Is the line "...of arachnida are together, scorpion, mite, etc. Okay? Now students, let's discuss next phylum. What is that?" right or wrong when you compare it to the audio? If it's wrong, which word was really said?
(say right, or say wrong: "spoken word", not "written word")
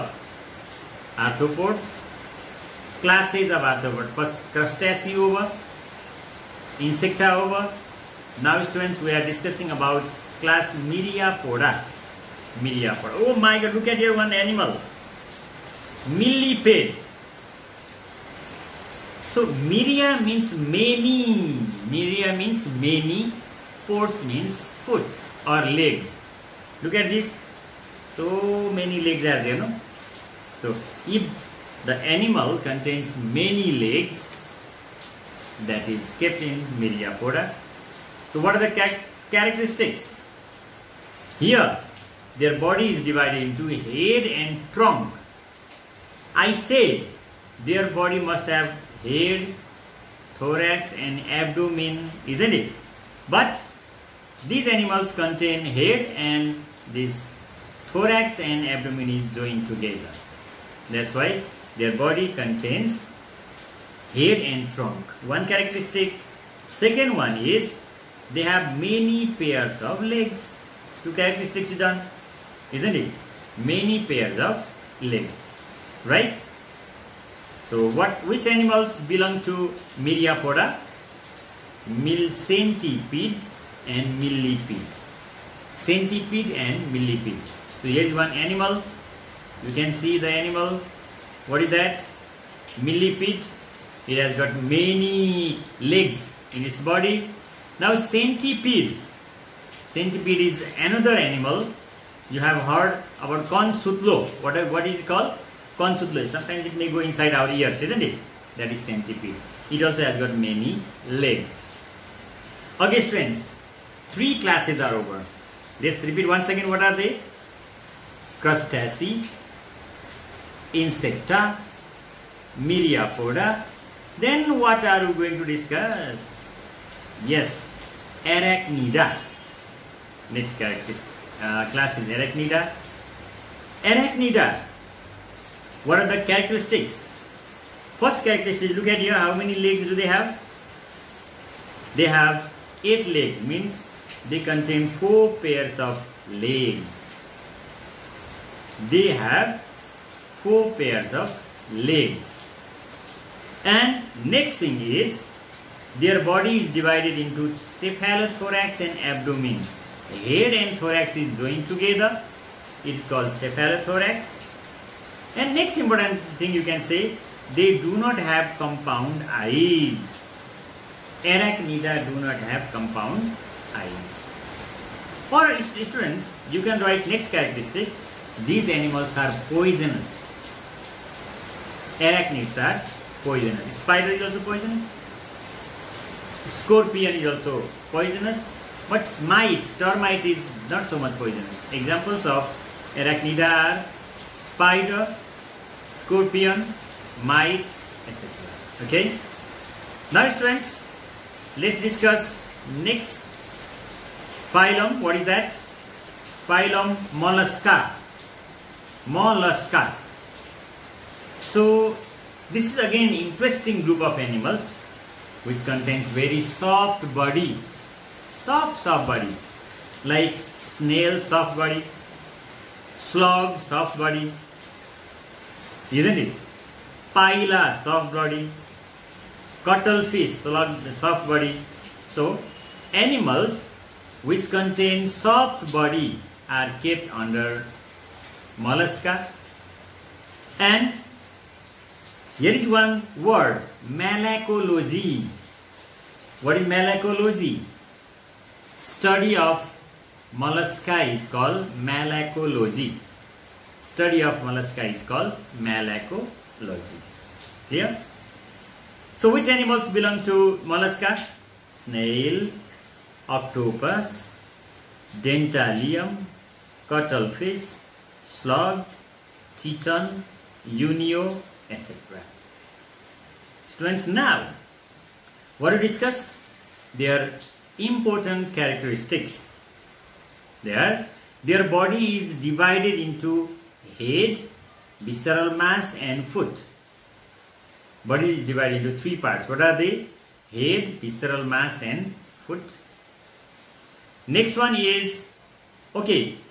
wrong: "spider", not "together".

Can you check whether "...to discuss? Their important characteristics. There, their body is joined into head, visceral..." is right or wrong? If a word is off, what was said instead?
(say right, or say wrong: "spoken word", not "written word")
wrong: "divided", not "joined".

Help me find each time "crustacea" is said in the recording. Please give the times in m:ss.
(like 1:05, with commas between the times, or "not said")
0:04, 1:58.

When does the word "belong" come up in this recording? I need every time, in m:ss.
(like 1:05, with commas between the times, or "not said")
1:19, 4:19.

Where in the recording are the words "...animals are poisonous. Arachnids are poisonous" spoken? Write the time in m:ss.
2:58.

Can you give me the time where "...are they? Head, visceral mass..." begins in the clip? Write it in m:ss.
4:49.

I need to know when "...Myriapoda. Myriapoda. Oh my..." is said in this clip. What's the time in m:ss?
0:10.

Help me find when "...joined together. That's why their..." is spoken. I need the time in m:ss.
0:59.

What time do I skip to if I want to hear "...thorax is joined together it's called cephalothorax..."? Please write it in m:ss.
2:40.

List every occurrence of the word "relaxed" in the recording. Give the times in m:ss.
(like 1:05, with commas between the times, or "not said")
not said.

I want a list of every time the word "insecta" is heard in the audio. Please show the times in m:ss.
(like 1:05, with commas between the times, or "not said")
0:06, 2:00.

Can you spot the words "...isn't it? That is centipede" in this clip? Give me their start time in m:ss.
1:47.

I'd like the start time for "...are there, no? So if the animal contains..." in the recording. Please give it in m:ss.
0:29.